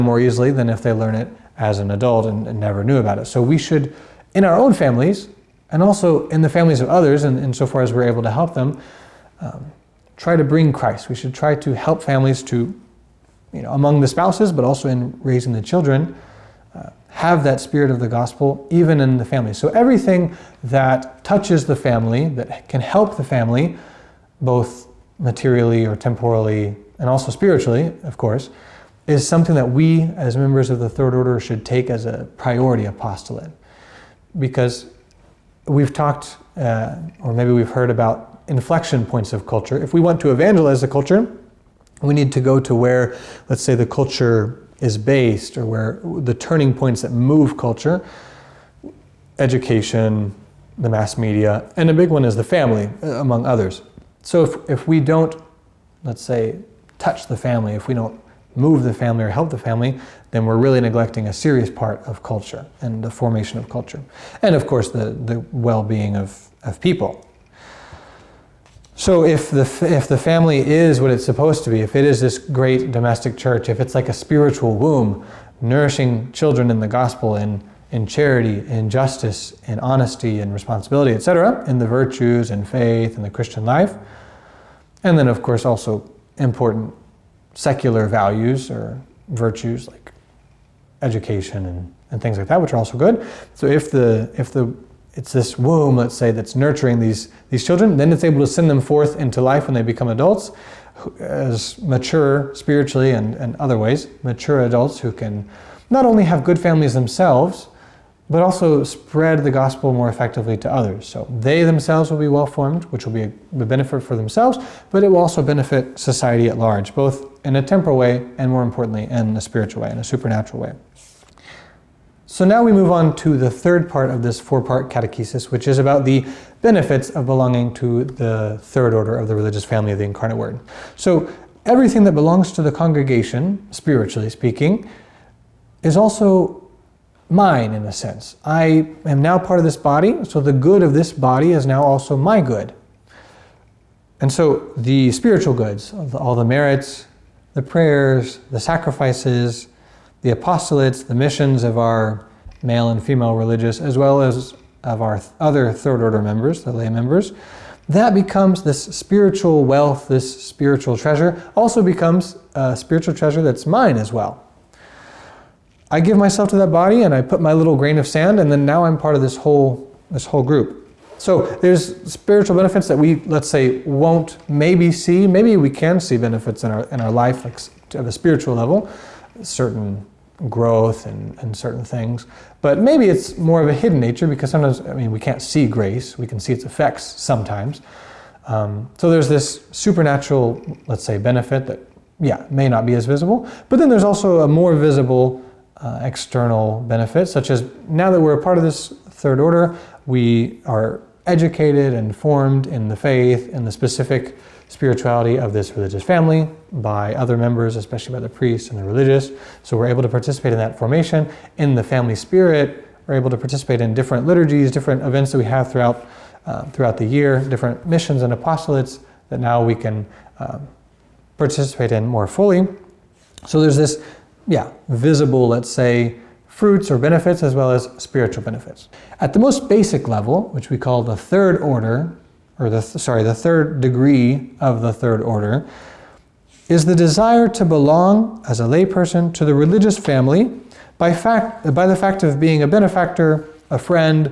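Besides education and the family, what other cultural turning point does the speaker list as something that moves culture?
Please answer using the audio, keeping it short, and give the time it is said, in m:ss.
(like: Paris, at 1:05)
The mass media, at 0:50.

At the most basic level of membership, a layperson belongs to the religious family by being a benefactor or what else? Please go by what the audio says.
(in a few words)
A friend.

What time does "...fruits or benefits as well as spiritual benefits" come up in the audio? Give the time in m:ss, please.
3:46.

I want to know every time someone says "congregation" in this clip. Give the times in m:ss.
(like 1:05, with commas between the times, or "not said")
2:12.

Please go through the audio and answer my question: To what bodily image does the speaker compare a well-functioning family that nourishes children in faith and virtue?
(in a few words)
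A spiritual womb.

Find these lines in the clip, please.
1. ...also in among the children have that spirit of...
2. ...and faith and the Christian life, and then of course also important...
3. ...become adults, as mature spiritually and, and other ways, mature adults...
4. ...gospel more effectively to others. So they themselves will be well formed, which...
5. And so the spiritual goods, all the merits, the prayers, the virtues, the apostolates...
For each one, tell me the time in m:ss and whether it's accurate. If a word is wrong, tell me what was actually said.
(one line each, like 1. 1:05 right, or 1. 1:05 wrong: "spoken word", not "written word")
1. 0:14 wrong: "raising", not "among"
2. 1:22 right
3. 1:39 right
4. 1:49 right
5. 2:24 wrong: "sacrifices", not "virtues".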